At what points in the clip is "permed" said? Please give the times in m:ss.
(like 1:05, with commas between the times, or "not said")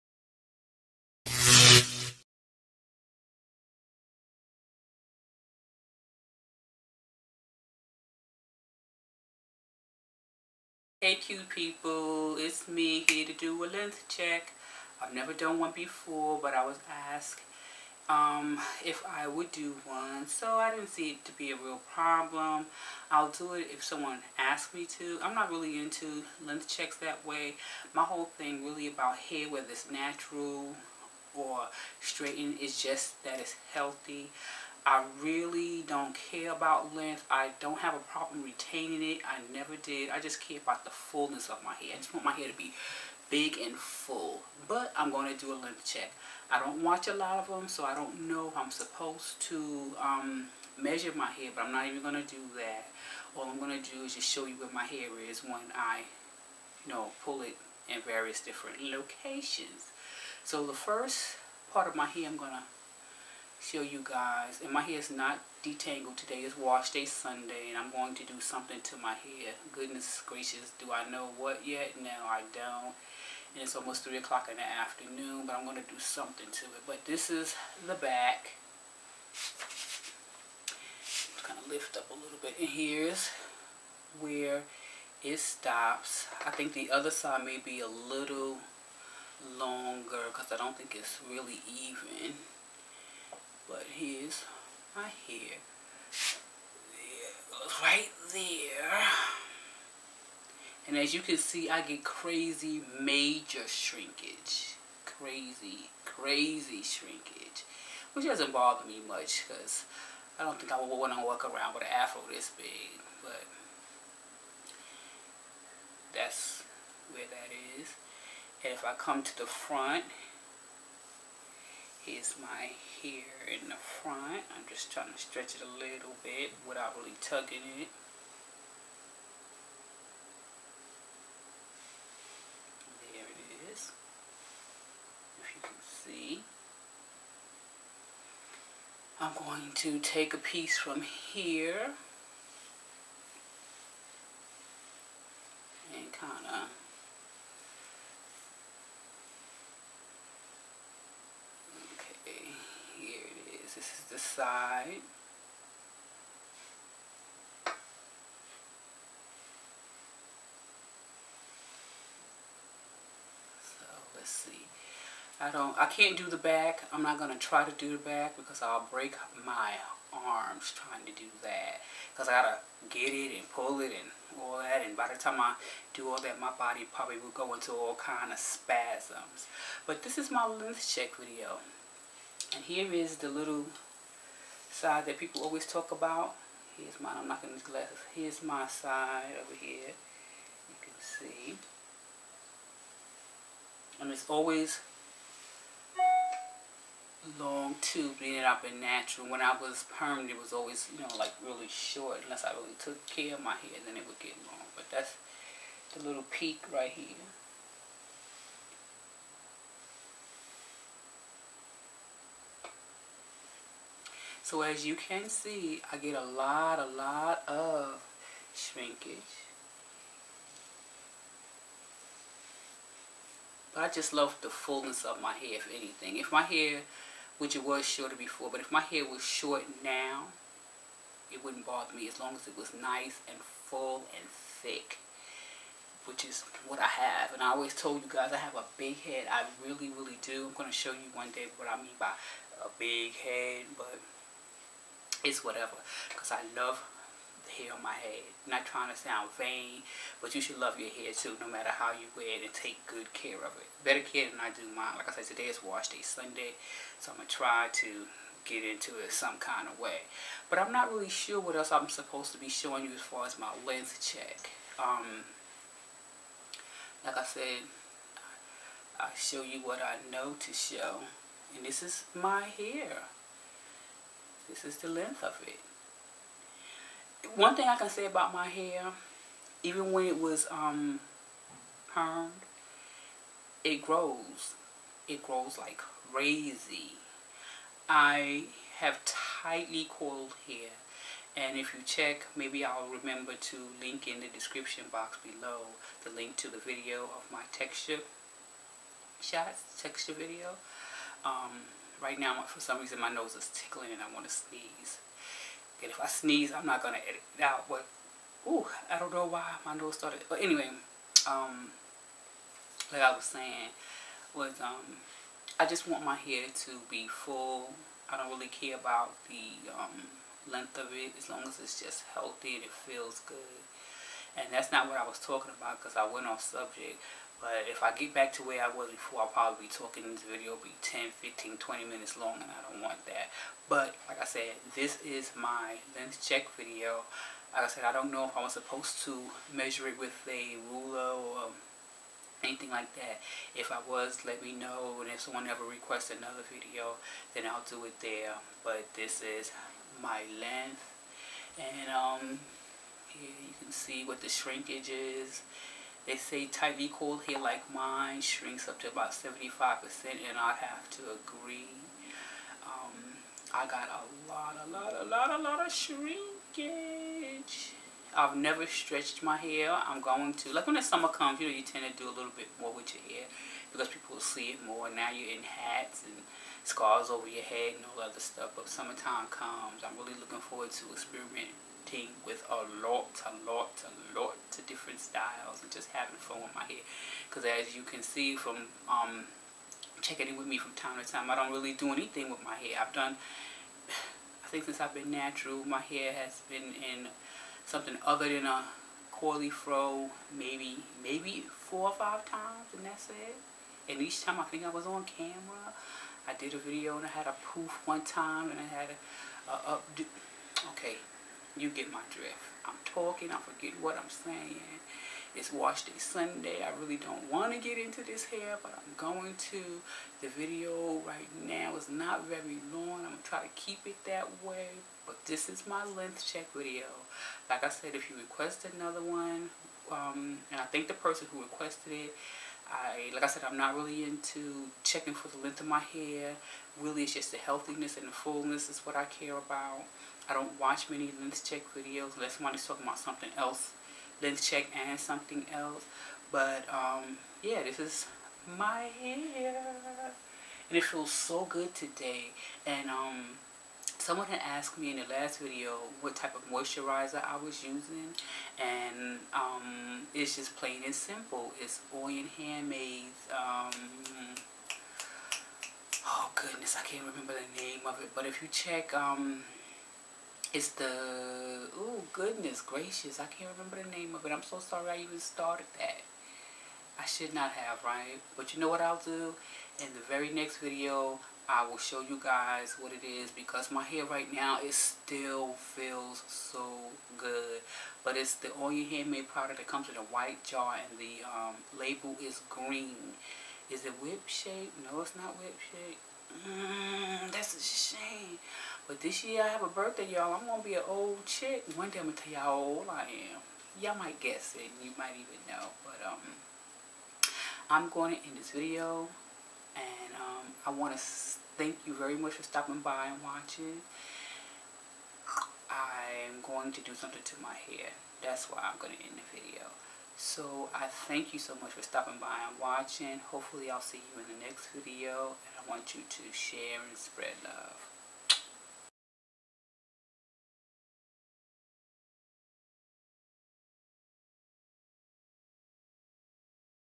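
3:19, 4:41.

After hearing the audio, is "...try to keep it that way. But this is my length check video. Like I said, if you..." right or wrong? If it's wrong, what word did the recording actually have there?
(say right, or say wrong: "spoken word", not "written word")
right.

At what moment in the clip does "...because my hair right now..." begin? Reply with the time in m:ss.
8:03.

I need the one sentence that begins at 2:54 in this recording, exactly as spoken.
And by the time I do all that, my body probably will go into all kind of spasms.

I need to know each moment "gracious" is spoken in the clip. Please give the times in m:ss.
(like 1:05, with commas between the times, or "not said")
1:10, 7:52.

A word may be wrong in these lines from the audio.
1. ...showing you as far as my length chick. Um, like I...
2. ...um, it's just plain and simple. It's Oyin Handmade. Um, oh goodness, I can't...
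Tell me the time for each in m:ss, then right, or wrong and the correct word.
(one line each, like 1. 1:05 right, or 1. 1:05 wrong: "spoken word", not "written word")
1. 4:22 wrong: "check", not "chick"
2. 7:39 right.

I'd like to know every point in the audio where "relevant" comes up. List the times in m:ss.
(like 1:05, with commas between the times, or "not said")
not said.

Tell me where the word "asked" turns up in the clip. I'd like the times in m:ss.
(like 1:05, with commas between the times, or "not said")
0:17, 7:34.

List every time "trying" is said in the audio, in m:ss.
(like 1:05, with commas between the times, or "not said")
2:04, 2:50, 4:08.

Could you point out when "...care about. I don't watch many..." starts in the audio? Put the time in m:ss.
7:19.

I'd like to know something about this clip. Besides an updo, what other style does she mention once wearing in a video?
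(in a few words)
A poof.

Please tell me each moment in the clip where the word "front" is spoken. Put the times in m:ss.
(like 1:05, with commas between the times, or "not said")
1:59, 2:03.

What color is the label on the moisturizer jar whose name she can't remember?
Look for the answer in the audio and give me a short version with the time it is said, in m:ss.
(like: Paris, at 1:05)
Green, at 8:10.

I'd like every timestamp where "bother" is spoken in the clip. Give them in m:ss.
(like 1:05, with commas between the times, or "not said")
1:48, 3:51.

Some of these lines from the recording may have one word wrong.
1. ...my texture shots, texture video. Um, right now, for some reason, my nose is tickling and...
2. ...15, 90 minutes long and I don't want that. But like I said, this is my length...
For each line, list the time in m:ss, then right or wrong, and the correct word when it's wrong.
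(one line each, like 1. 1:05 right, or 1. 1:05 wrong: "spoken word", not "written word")
1. 4:57 right
2. 5:31 wrong: "20", not "90".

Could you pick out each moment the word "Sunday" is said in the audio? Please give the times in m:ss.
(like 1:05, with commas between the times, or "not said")
1:07, 4:16, 6:55.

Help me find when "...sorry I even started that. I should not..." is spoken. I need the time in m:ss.
7:54.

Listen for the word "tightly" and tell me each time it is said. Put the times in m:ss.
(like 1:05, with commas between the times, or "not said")
4:49, 5:56.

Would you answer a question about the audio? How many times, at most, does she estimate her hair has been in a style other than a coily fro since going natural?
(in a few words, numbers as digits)
5.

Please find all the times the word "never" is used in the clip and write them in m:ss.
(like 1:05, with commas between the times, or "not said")
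0:15, 0:39, 6:08.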